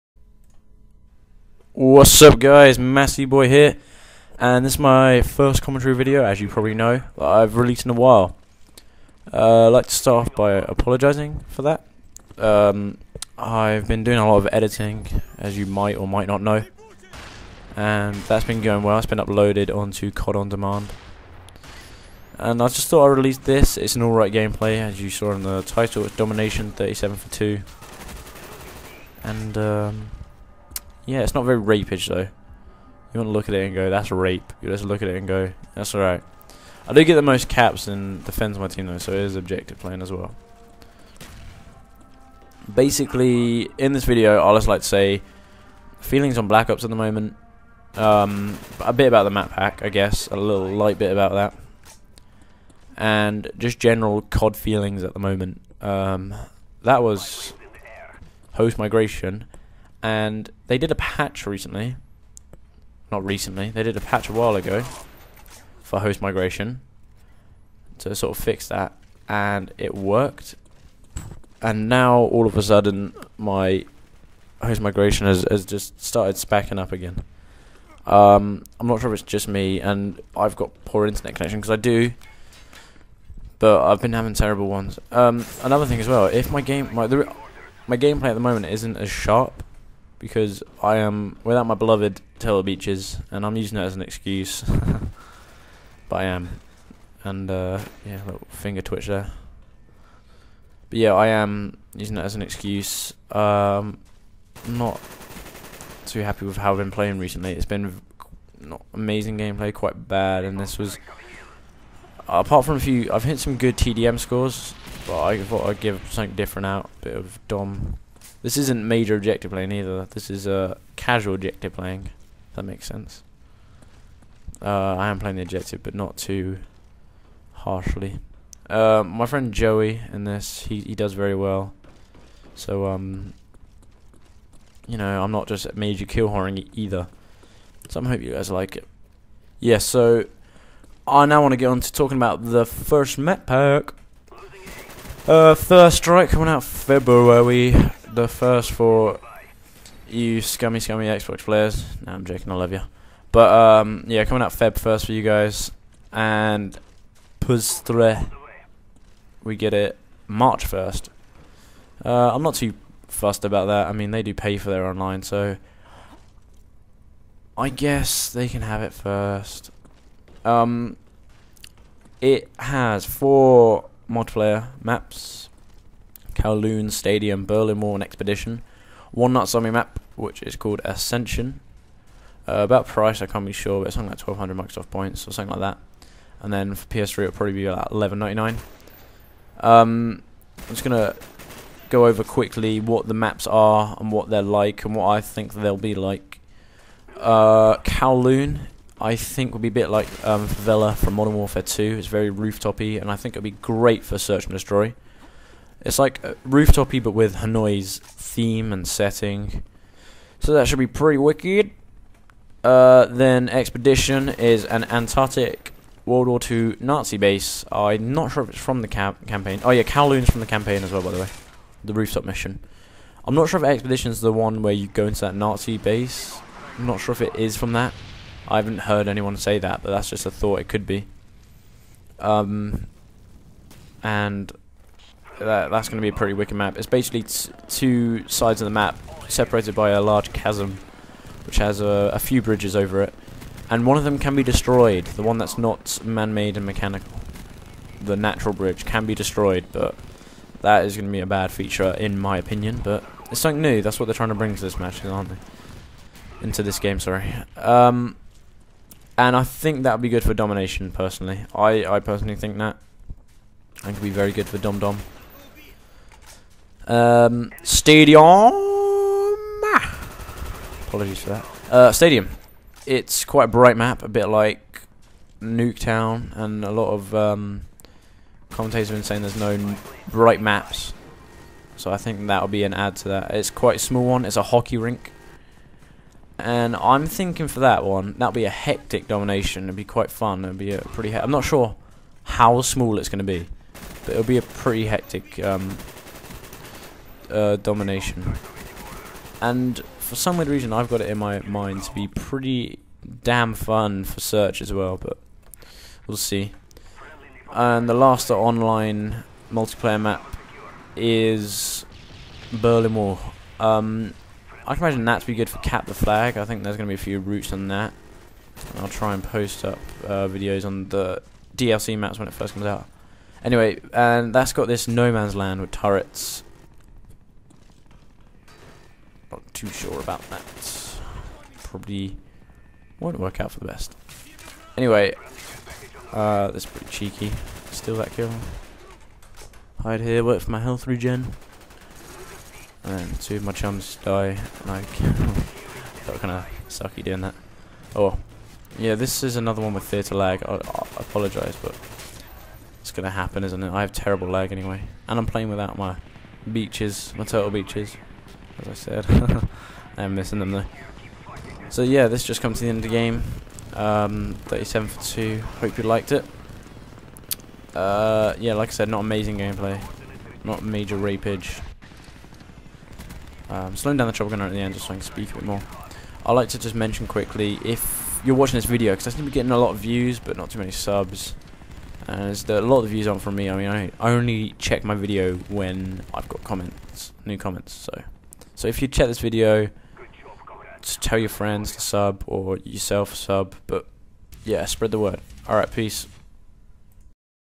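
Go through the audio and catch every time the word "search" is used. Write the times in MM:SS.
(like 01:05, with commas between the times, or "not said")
03:24, 05:04.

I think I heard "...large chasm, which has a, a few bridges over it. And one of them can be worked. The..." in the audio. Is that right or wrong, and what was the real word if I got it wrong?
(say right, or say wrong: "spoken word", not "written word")
wrong: "destroyed", not "worked".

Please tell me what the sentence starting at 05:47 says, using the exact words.
Oh, yeah, this is another one with theatre lag.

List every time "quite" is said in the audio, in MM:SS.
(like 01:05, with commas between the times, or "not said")
01:49, 04:33, 04:43, 04:49.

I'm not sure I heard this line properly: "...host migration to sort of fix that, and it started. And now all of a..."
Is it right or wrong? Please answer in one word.
wrong.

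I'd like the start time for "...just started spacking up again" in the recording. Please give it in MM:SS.
01:15.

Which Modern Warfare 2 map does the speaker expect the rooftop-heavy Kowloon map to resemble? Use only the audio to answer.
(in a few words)
Favela.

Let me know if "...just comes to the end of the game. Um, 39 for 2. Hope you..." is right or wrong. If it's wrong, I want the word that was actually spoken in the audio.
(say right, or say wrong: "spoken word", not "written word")
wrong: "37", not "39".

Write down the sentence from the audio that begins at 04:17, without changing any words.
Um, and I think that would be good for domination, personally.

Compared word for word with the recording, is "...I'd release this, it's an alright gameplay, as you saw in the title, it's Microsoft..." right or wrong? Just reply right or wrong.
wrong.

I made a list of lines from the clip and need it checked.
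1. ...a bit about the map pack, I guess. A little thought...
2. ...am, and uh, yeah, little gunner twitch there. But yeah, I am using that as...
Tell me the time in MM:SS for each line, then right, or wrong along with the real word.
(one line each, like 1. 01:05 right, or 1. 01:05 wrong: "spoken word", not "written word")
1. 00:48 wrong: "light", not "thought"
2. 01:36 wrong: "finger", not "gunner".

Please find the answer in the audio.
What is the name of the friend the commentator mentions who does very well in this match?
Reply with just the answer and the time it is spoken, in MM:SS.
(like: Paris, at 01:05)
Joey, at 02:09.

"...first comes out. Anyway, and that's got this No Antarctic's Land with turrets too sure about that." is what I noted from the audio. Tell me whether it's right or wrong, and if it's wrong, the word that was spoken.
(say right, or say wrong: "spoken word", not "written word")
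wrong: "Man", not "Antarctic".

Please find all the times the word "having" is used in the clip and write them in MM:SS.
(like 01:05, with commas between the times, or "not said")
01:24.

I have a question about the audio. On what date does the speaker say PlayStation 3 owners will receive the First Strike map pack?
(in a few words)
March 1.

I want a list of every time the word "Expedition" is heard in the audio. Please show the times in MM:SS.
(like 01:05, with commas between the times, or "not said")
02:58, 03:33, 03:43.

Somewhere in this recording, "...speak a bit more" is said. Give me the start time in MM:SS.
06:15.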